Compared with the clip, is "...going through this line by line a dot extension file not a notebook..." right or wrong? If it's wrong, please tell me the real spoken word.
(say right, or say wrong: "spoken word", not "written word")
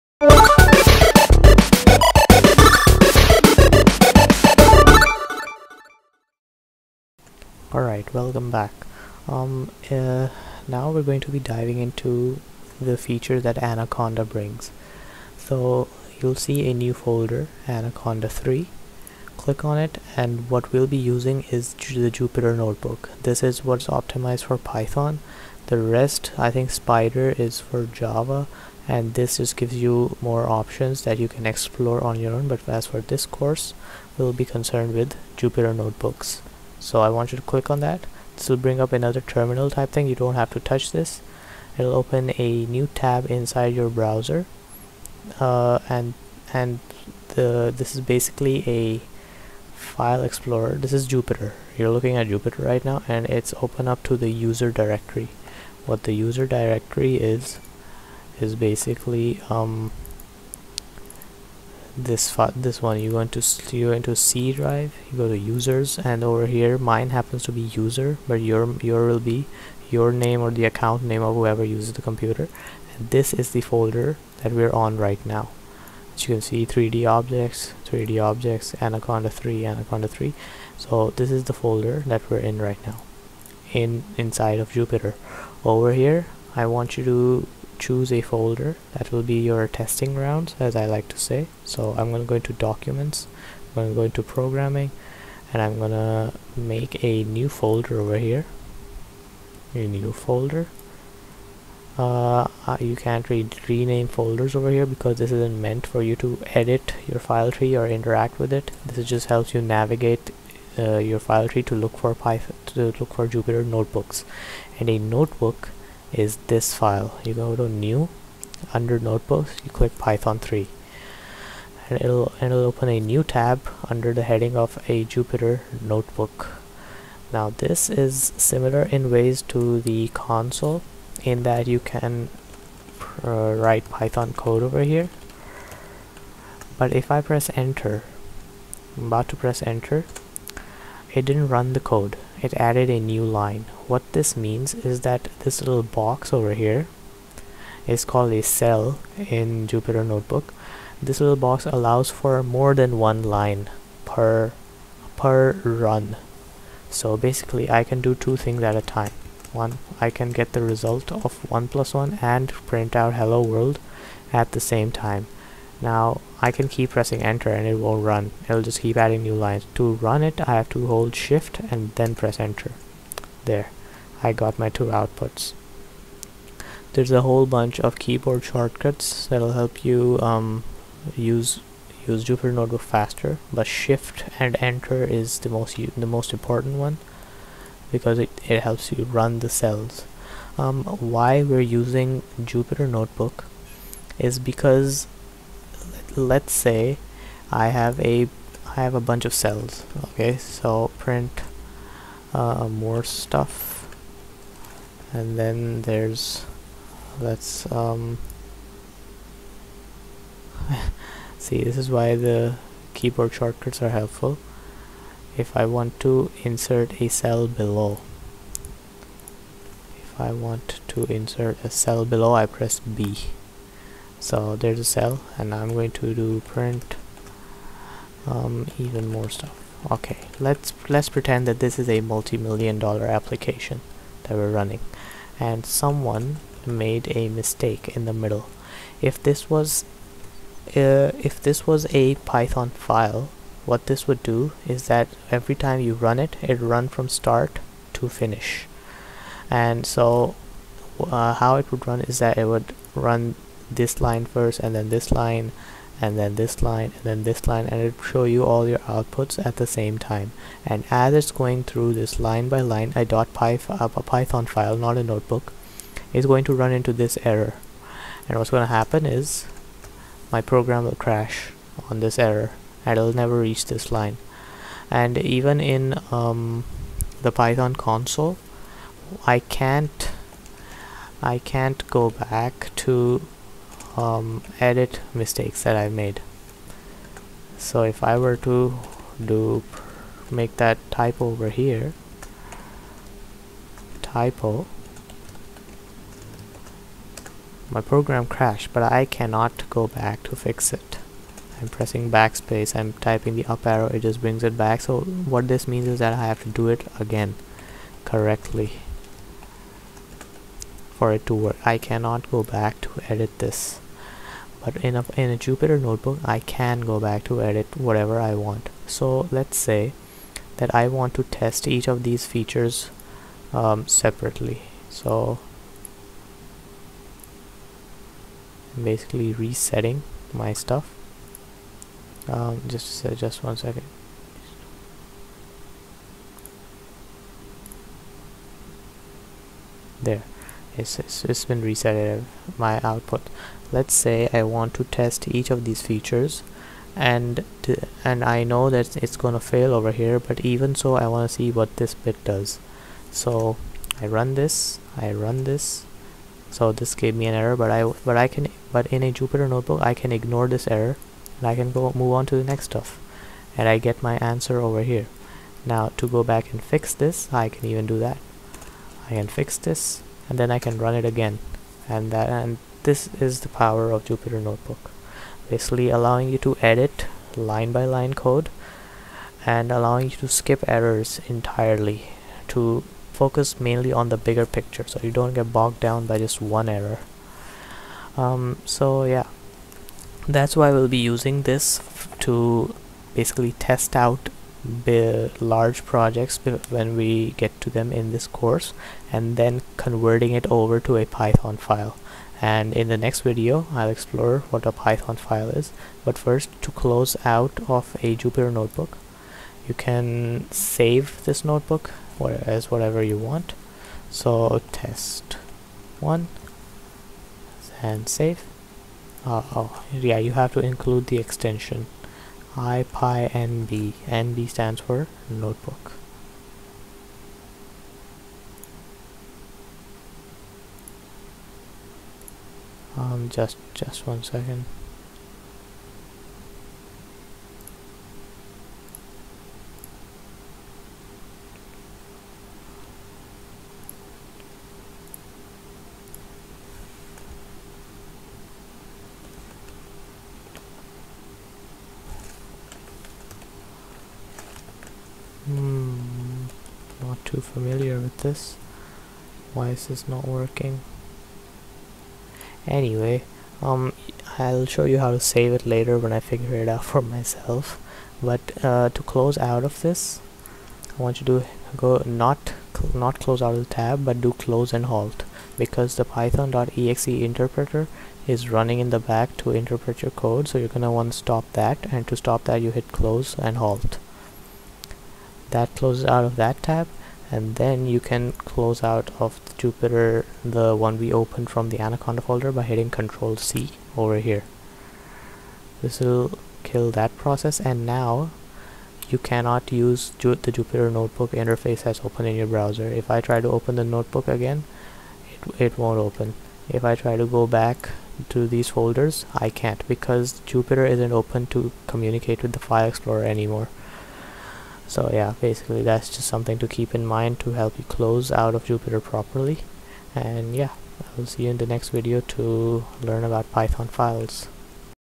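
wrong: "python", not "extension".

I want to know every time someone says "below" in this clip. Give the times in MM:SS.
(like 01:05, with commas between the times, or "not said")
03:37, 03:42.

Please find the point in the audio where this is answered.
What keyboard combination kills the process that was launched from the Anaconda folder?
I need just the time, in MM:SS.
08:12.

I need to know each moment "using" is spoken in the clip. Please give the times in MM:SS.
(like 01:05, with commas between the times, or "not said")
00:20, 03:11, 06:31.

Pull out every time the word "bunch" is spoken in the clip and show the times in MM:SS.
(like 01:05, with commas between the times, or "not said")
02:57, 03:19.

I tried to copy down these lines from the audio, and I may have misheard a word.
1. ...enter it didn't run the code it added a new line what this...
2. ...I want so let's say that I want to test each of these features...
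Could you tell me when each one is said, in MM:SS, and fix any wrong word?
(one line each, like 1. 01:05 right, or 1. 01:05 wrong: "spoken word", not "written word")
1. 02:19 right
2. 05:18 right.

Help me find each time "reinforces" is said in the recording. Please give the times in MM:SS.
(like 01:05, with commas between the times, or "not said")
not said.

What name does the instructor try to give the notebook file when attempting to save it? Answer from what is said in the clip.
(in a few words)
test one.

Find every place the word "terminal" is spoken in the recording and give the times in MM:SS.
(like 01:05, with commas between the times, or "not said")
00:39.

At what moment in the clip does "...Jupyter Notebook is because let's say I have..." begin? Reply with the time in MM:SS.
03:12.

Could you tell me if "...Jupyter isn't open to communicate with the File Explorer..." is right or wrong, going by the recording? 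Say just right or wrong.
right.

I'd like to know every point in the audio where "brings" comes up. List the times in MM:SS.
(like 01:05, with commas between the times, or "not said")
00:14, 00:38, 05:04.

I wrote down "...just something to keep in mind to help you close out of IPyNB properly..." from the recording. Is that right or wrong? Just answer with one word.
wrong.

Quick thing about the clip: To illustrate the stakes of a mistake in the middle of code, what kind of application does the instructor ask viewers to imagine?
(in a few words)
multi-million dollar application.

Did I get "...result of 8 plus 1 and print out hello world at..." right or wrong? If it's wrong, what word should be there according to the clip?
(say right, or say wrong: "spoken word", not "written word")
wrong: "1", not "8".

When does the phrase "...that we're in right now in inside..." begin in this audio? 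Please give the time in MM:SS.
01:22.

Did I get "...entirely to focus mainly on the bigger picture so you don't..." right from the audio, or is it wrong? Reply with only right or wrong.
right.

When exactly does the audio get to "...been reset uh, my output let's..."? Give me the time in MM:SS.
05:41.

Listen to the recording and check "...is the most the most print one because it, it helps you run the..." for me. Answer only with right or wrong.
wrong.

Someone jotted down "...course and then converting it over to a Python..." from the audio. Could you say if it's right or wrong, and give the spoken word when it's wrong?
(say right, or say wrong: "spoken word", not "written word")
right.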